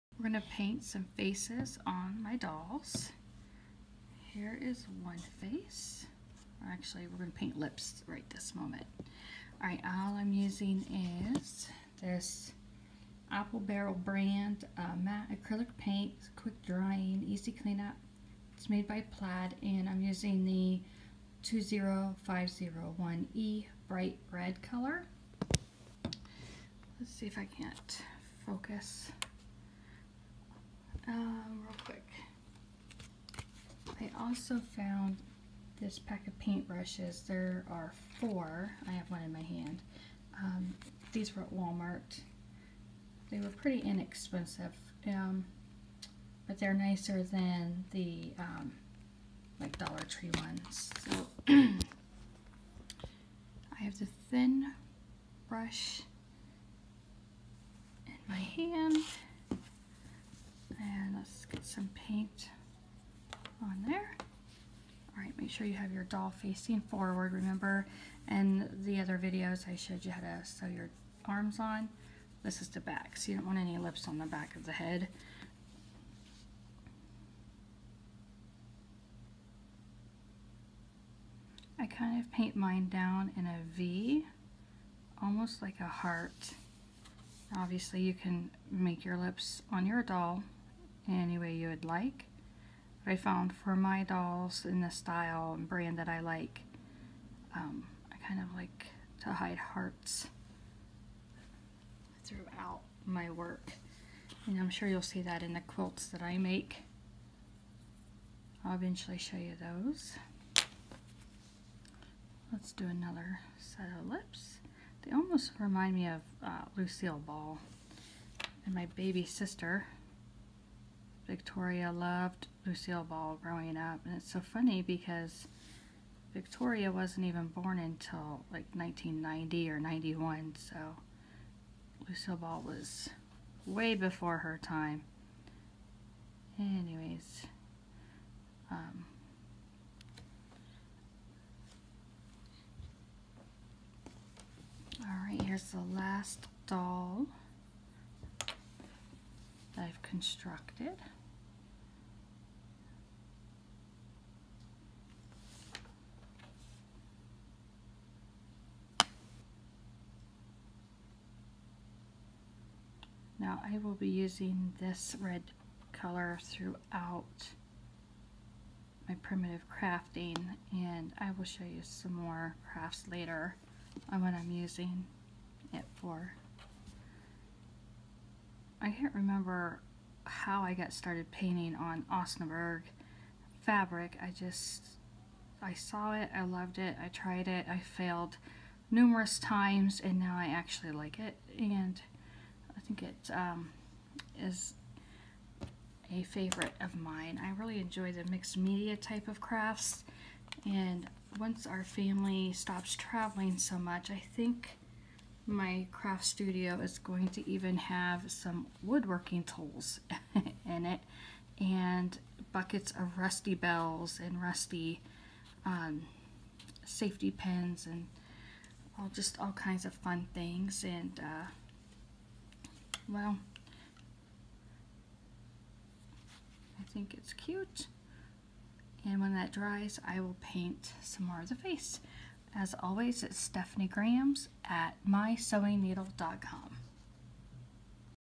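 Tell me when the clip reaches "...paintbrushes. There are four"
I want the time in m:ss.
0:36.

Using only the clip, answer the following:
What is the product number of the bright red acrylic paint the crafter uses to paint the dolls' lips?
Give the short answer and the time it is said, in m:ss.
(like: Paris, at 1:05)
20501E, at 0:21.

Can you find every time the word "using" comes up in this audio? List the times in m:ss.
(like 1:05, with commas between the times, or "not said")
0:10, 0:20, 2:44, 2:54.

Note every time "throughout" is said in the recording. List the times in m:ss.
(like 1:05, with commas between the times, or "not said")
1:42, 2:46.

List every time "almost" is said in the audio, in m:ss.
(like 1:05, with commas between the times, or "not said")
1:25, 1:55.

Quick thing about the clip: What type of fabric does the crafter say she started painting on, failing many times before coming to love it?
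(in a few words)
Osnaburg.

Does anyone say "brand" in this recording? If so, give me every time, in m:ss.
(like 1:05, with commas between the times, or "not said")
0:13, 1:35.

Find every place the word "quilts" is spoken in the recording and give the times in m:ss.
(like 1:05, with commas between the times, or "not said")
1:45.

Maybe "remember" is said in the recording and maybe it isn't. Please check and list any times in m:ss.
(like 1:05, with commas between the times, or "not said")
1:07, 2:59.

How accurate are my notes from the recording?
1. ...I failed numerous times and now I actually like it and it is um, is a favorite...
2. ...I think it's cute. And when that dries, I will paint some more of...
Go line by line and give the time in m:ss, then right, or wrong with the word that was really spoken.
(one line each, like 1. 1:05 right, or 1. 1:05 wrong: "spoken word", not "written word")
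1. 3:07 right
2. 3:46 right.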